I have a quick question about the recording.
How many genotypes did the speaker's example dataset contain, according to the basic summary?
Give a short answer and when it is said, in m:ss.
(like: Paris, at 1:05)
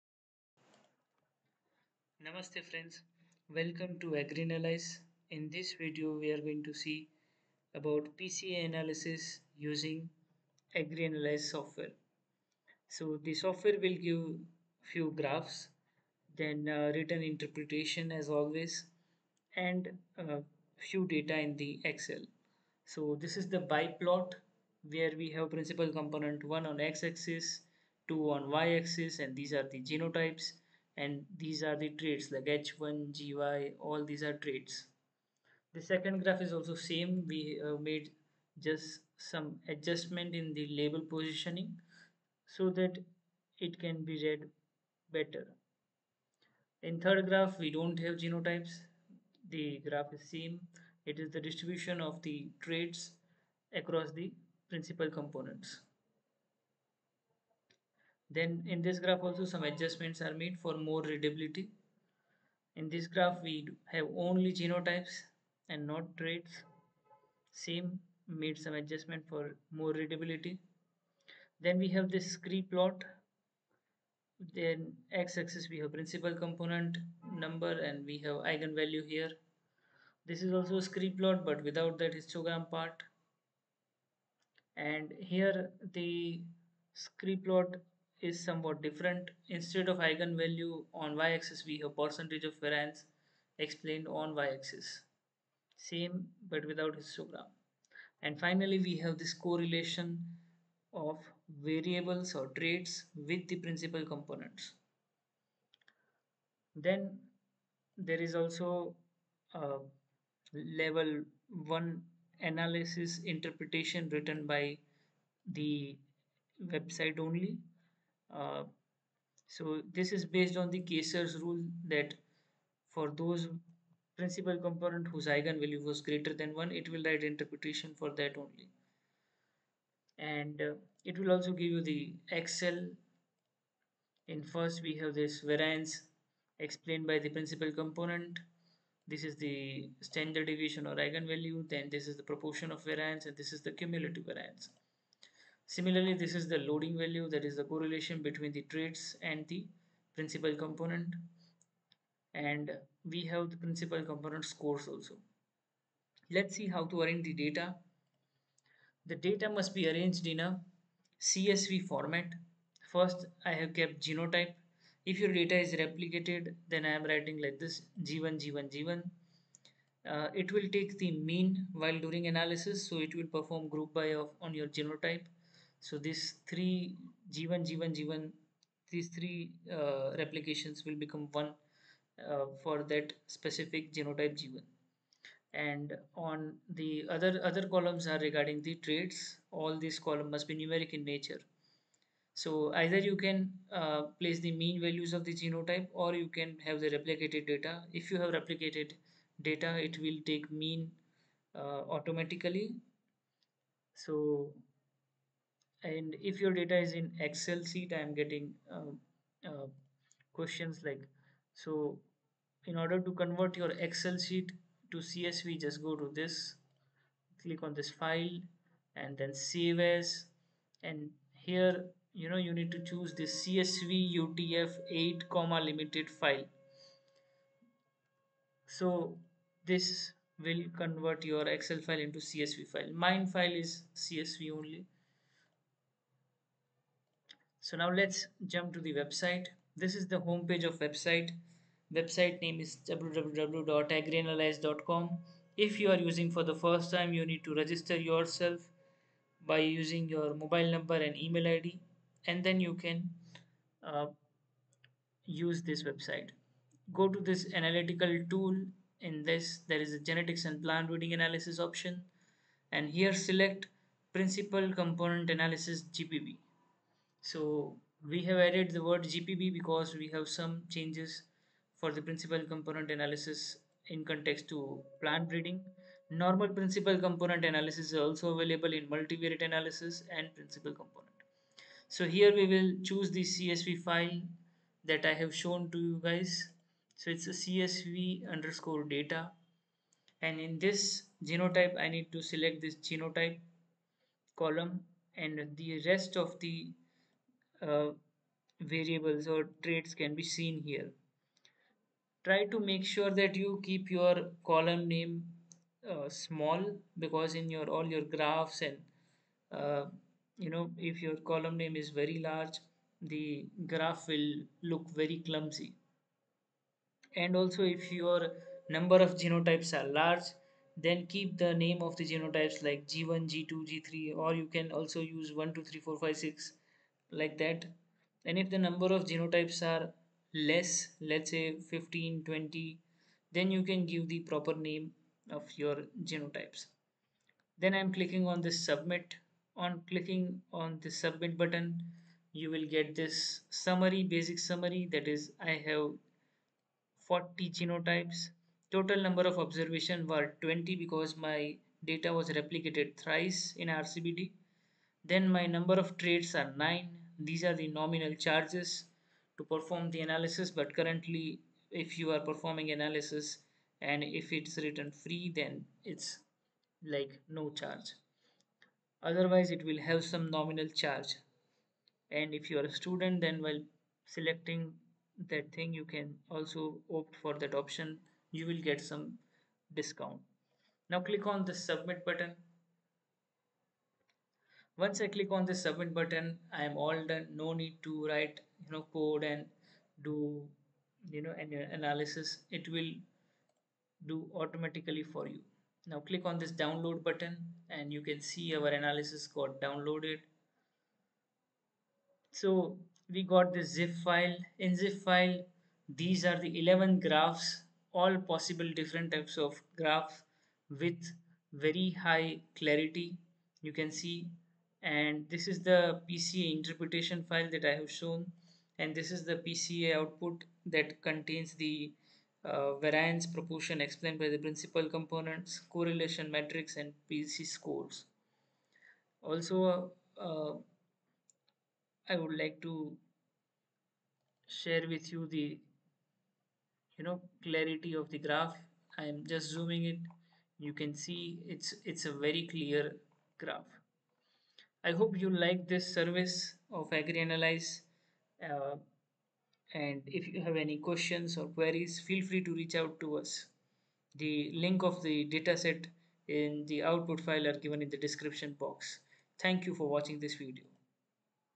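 40, at 5:47.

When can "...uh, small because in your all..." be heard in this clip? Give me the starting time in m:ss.
5:05.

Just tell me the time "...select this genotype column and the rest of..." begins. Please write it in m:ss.
4:52.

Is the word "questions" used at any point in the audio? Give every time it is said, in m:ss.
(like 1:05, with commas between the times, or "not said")
3:30, 7:30.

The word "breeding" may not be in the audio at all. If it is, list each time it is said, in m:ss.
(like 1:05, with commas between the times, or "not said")
4:20, 4:35.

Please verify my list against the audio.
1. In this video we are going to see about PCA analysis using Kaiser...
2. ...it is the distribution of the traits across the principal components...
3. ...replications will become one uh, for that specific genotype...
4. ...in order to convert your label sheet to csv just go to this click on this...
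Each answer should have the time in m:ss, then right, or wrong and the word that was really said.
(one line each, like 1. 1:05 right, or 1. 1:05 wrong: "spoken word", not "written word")
1. 0:05 wrong: "AgriAnalyze", not "Kaiser"
2. 0:51 right
3. 3:00 right
4. 3:32 wrong: "excel", not "label".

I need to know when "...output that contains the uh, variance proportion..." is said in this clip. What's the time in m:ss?
6:59.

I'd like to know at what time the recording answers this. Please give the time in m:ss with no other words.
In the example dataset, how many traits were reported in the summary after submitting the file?
5:56.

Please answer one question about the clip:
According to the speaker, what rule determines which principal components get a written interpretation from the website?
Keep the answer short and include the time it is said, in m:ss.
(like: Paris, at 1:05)
Kaiser's rule, at 2:00.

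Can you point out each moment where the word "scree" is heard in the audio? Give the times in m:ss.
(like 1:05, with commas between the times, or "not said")
1:12, 1:20, 1:26.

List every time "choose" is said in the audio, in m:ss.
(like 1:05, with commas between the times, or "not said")
3:42, 4:42.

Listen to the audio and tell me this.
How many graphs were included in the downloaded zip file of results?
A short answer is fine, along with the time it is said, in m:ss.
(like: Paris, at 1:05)
11, at 6:46.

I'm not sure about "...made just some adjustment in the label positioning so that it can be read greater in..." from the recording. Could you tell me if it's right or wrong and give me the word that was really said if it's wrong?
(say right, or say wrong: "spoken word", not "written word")
wrong: "better", not "greater".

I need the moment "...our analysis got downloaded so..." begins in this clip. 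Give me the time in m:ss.
6:38.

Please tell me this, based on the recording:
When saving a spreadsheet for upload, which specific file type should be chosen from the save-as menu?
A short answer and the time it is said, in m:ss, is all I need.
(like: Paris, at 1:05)
CSV UTF-8 comma delimited, at 3:43.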